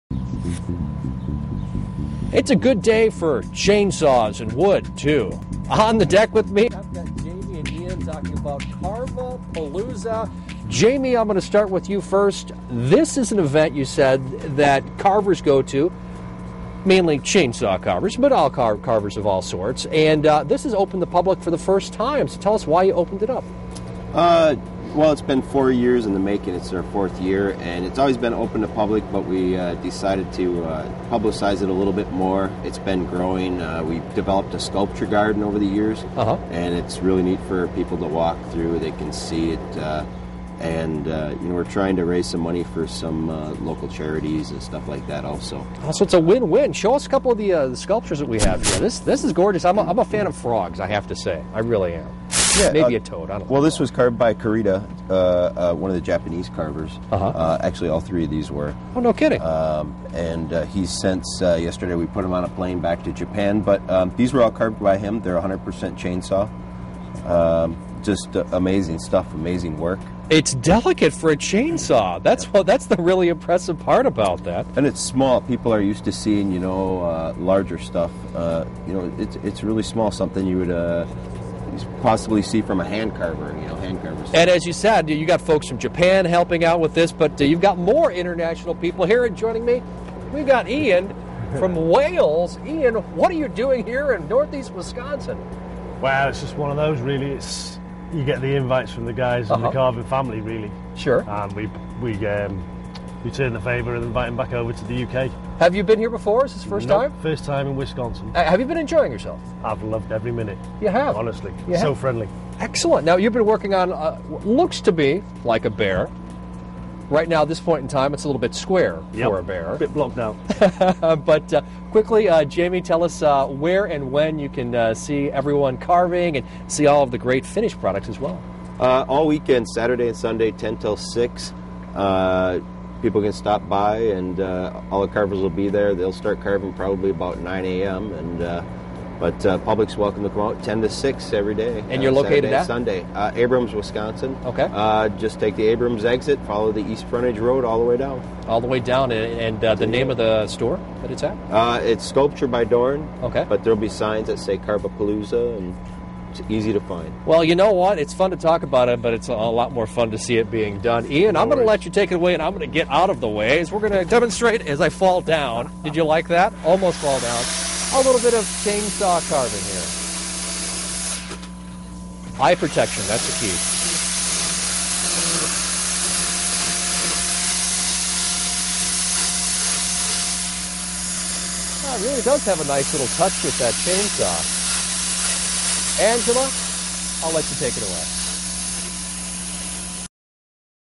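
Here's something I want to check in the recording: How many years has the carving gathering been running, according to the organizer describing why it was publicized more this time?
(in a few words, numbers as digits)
4.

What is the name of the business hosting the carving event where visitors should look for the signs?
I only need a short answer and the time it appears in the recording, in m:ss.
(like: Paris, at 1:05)
Sculpture by Dorn, at 2:32.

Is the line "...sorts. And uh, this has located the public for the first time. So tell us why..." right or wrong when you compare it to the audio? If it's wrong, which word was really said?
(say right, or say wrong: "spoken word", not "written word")
wrong: "opened", not "located".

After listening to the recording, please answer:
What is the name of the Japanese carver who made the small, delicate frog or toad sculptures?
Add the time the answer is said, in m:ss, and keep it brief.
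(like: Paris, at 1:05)
Karita, at 0:54.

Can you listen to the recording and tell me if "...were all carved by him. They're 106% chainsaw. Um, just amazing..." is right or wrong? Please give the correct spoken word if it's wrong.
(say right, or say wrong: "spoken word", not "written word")
wrong: "100", not "106".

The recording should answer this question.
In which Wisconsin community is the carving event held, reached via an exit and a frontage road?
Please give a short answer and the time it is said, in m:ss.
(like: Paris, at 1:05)
Abrams, Wisconsin, at 2:23.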